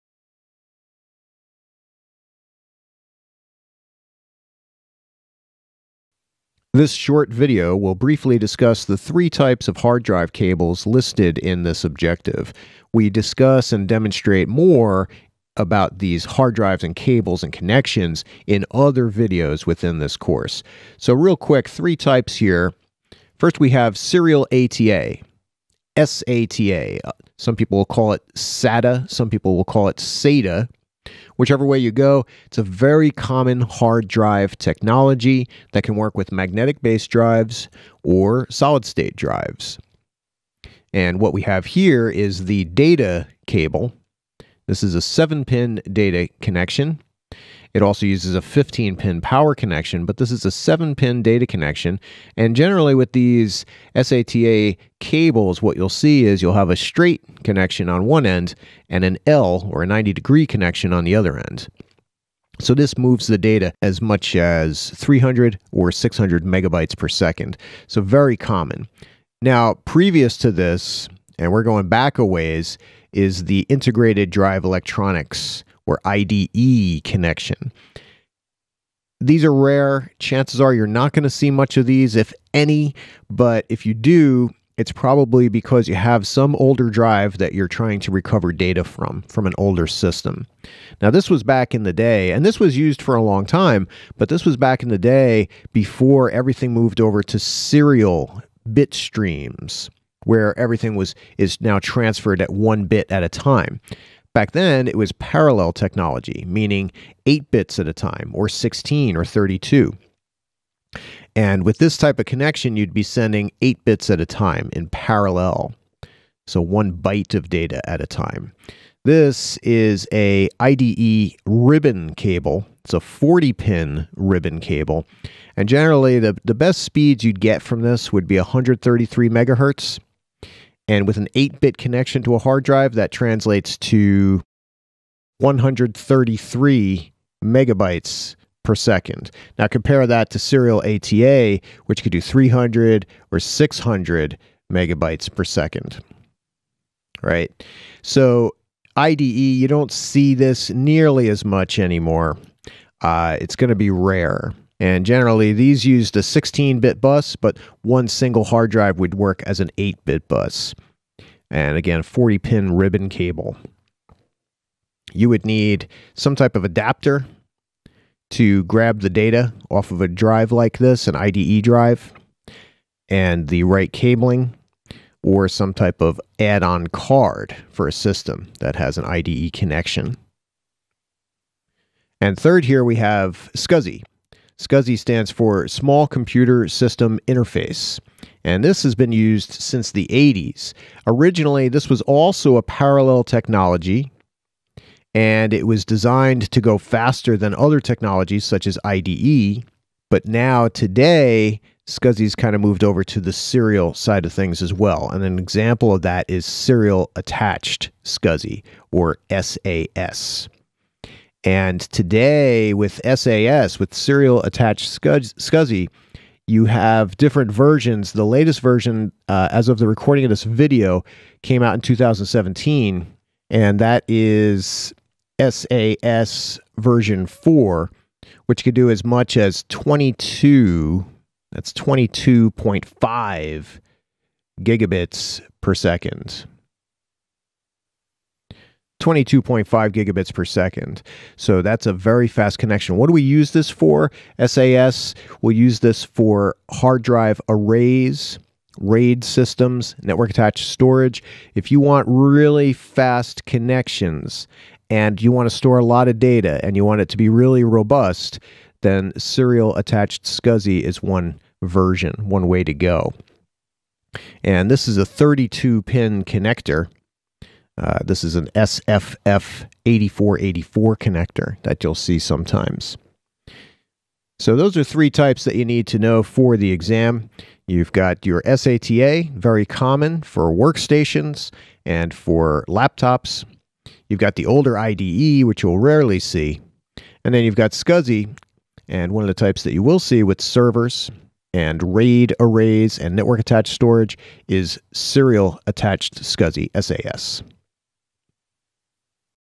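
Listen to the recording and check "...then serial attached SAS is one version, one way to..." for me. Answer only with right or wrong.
wrong.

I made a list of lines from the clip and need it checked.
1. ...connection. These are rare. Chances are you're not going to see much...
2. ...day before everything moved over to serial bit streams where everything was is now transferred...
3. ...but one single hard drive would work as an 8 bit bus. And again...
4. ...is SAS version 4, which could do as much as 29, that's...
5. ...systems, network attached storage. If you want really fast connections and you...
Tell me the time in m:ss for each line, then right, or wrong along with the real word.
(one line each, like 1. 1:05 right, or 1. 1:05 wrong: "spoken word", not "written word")
1. 1:17 right
2. 1:34 right
3. 2:37 right
4. 3:44 wrong: "22", not "29"
5. 4:09 right.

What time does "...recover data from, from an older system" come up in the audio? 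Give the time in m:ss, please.
1:28.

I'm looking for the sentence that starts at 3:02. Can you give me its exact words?
And third, here we have SCSI, SCSI stands for Small Computer System Interface, and this has been used since the 80s.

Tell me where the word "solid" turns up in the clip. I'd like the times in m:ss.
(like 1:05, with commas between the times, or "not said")
0:38.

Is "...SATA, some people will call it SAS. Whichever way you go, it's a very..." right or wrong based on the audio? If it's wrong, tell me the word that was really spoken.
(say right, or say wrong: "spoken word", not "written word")
wrong: "SATA", not "SAS".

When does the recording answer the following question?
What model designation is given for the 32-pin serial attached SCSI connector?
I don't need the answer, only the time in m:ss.
4:28.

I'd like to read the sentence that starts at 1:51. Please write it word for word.
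And with this type of connection, you'd be sending 8 bits at a time in parallel.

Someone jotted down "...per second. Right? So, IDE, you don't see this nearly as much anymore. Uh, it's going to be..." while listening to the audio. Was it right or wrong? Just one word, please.
right.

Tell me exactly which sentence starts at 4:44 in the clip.
You've got the older IDE, which you'll rarely see.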